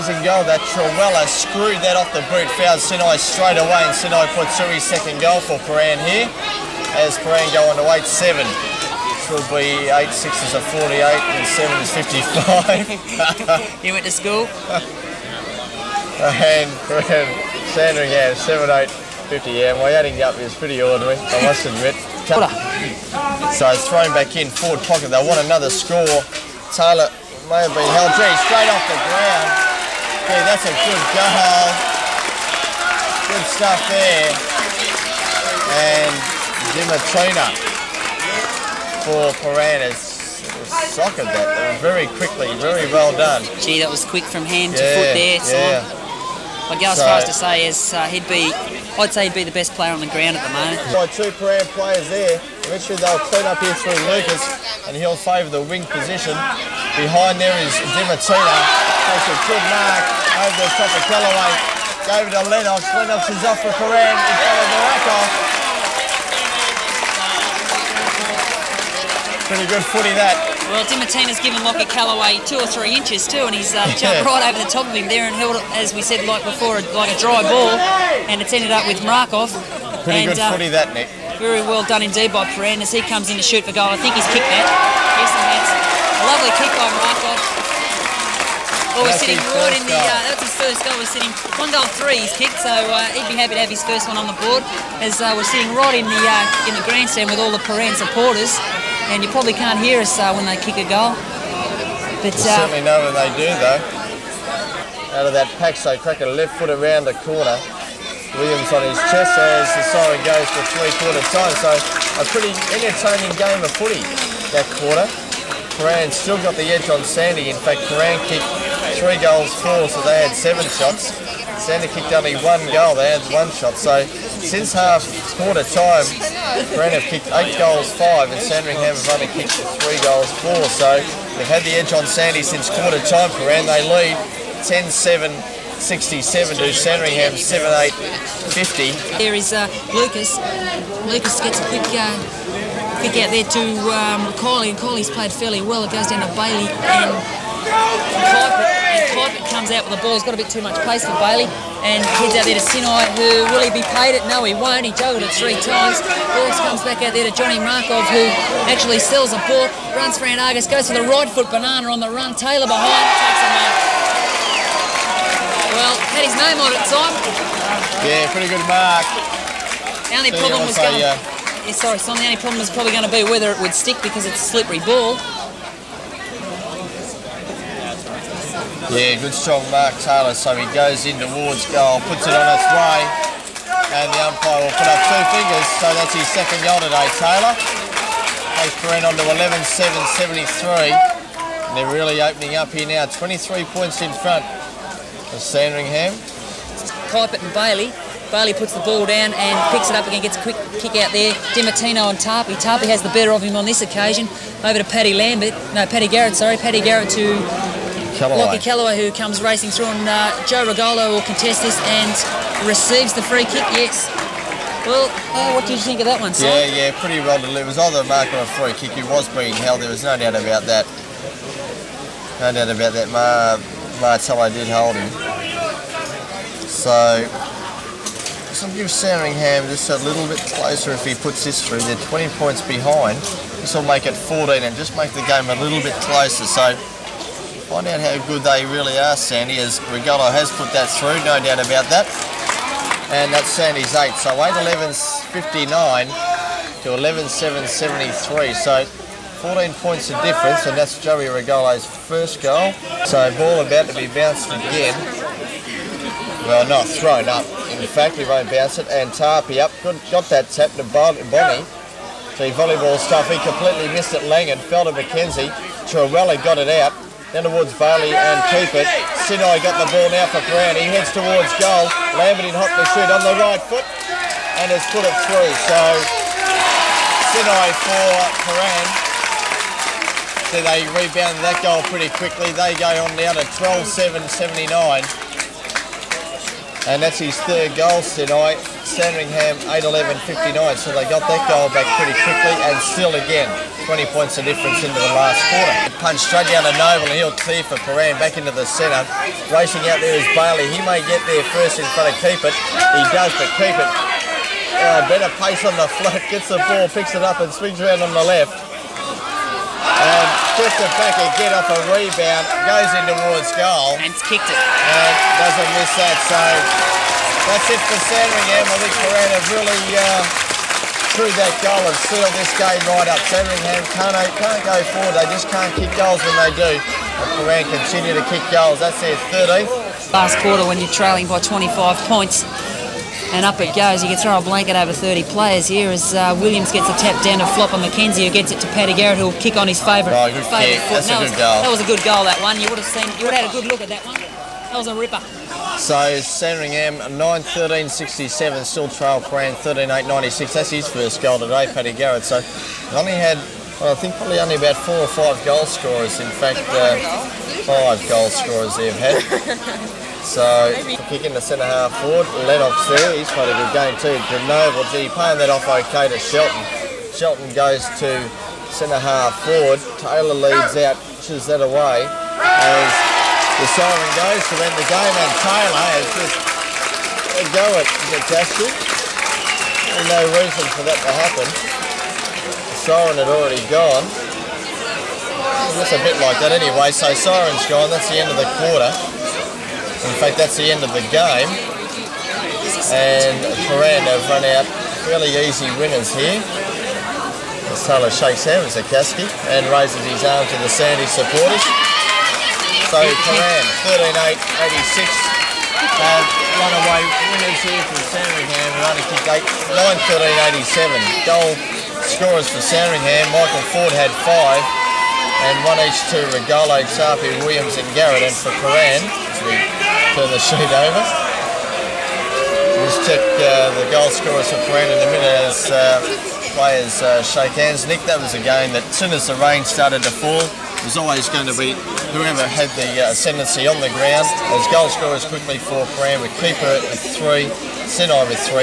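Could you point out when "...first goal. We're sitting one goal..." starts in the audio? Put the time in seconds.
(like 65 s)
90 s.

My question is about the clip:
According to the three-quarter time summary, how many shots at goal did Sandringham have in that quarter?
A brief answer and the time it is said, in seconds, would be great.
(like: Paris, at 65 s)
1, at 123 s.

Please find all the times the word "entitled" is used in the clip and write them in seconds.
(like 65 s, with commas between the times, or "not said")
not said.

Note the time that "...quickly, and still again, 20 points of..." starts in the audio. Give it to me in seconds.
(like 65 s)
292 s.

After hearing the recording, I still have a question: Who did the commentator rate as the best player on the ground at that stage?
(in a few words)
Dimitrina.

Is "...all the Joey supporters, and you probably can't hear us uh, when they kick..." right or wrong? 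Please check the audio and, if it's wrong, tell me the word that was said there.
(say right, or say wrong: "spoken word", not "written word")
wrong: "Prahran", not "Joey".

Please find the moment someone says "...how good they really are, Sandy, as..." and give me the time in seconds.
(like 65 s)
238 s.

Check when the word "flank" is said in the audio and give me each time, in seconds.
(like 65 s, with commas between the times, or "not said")
306 s.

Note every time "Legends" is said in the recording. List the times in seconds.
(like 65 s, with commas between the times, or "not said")
not said.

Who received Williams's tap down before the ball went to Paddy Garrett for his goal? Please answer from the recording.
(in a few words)
Flopper McKenzie.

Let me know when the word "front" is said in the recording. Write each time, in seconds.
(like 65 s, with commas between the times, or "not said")
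64 s, 194 s, 301 s.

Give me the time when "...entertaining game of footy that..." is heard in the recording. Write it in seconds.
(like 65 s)
112 s.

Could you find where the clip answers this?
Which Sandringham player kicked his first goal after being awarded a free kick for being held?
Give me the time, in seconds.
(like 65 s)
251 s.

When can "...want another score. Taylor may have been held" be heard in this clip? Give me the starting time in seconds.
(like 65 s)
25 s.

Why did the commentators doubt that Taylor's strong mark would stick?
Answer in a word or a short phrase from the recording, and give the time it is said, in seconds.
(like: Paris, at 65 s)
slippery ball, at 174 s.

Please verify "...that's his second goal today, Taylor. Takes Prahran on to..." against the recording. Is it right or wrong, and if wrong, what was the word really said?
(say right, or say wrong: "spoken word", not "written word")
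right.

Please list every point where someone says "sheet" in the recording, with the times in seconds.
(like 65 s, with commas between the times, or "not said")
420 s.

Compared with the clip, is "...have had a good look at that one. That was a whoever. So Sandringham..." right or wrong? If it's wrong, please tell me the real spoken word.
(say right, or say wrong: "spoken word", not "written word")
wrong: "ripper", not "whoever".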